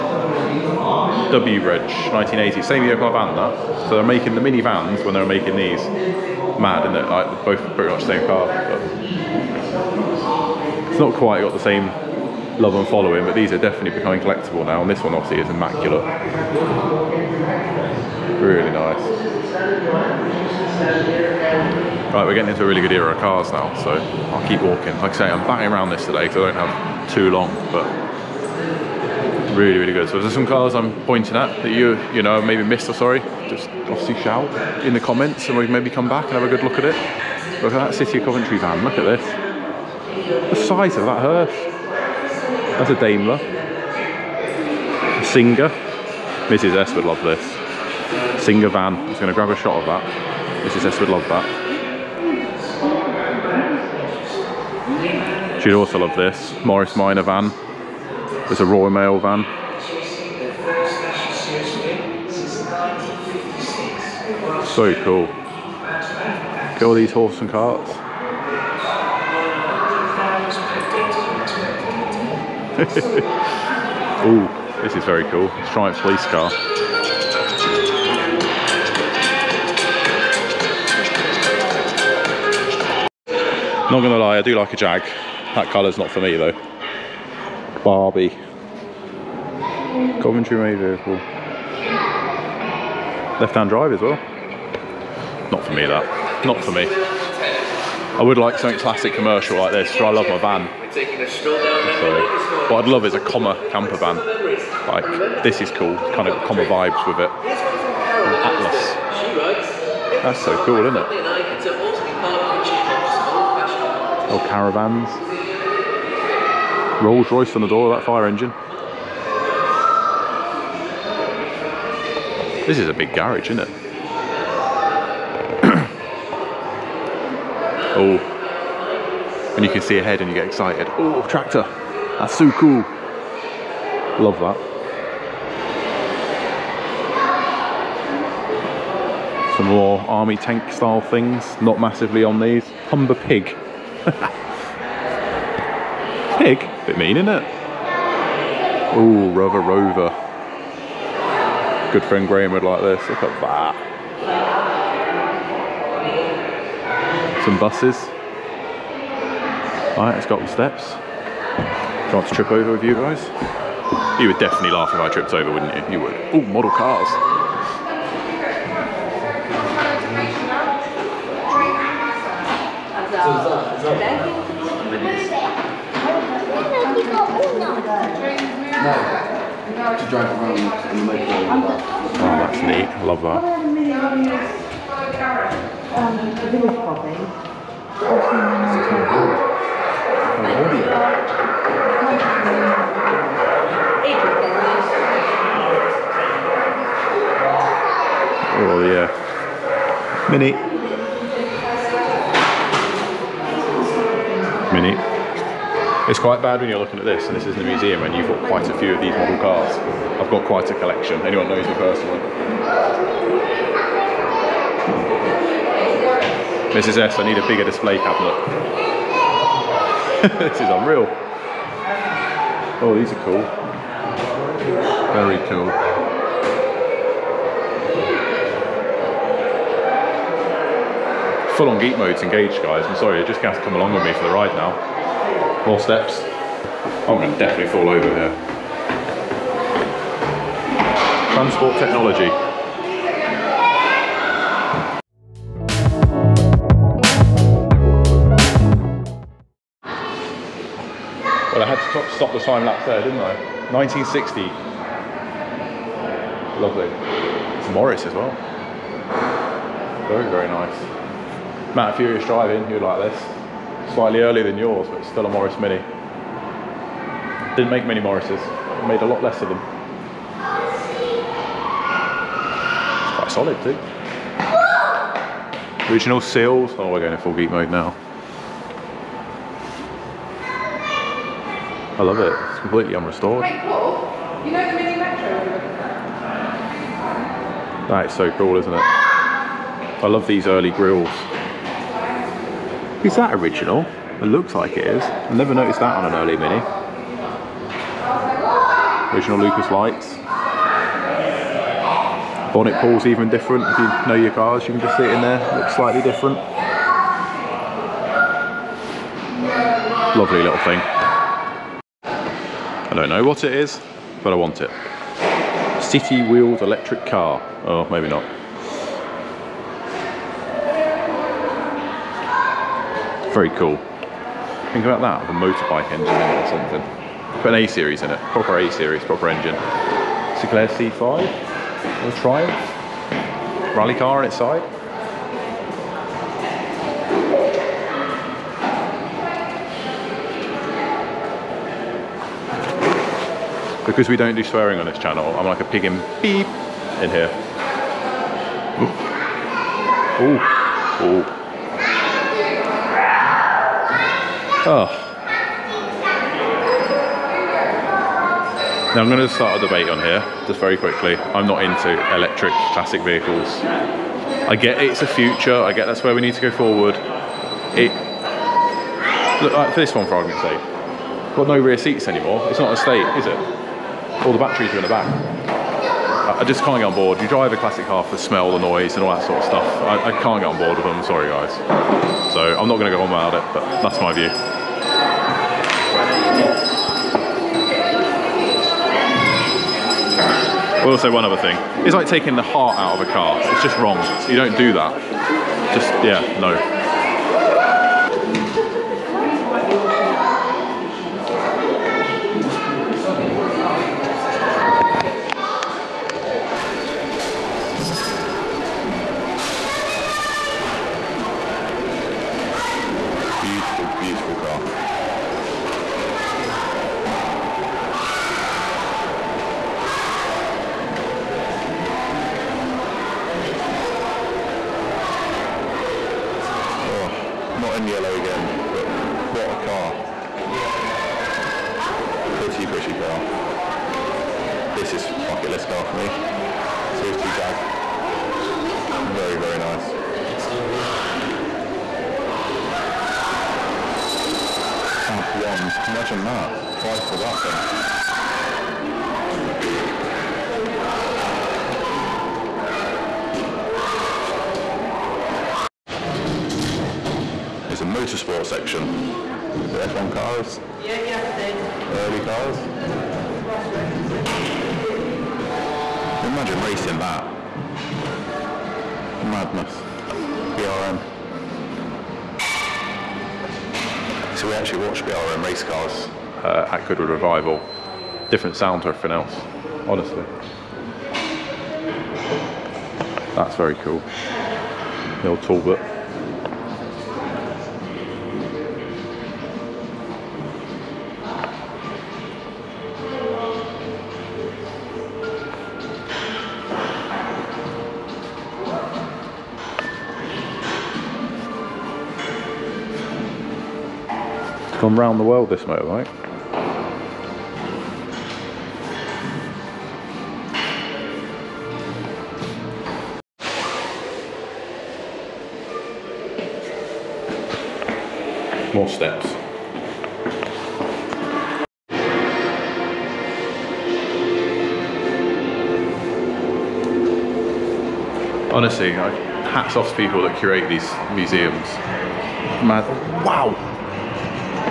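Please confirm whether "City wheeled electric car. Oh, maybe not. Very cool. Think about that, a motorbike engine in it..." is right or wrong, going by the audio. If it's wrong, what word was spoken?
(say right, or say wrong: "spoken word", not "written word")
right.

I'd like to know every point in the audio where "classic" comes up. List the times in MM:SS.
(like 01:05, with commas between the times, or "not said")
01:38, 06:02, 06:17.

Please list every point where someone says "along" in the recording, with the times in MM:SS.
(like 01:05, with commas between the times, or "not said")
03:53.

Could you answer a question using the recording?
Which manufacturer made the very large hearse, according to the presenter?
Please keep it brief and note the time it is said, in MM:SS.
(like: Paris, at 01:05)
Daimler, at 00:42.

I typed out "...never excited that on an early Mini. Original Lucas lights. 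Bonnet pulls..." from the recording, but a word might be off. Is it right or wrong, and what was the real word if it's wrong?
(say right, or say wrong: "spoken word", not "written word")
wrong: "noticed", not "excited".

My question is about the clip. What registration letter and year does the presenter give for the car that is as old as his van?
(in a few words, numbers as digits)
W Reg, 1980.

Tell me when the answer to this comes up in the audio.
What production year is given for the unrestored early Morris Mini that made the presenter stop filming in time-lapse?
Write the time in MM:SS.
04:13.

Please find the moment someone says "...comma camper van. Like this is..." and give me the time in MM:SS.
01:43.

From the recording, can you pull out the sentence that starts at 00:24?
Like I say, I'm batting around this today because I don't have too long, but really, really good.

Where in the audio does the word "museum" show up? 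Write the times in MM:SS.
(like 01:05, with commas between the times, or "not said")
03:27, 08:51.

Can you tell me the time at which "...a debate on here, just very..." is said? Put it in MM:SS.
05:59.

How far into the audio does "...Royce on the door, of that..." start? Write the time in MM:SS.
01:57.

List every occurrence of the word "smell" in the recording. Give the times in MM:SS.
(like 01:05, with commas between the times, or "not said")
06:18.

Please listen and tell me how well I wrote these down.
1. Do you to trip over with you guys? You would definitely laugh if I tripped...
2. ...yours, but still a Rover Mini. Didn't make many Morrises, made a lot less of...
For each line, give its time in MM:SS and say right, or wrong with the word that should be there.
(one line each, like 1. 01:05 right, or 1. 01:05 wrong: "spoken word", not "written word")
1. 02:42 right
2. 04:24 wrong: "Morris", not "Rover".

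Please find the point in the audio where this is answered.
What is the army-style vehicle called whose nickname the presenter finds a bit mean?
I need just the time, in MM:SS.
02:22.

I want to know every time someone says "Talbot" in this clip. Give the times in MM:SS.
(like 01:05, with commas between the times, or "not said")
08:05.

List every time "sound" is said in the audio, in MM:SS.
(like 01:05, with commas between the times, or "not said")
07:58.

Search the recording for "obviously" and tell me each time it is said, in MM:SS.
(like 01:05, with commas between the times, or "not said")
00:15, 00:33.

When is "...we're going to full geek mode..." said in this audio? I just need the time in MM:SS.
04:36.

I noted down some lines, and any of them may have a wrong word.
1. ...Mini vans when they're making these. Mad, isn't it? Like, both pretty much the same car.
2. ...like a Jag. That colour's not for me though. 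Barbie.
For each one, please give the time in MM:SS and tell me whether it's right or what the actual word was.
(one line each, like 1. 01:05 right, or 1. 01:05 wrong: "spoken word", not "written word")
1. 00:04 right
2. 01:24 right.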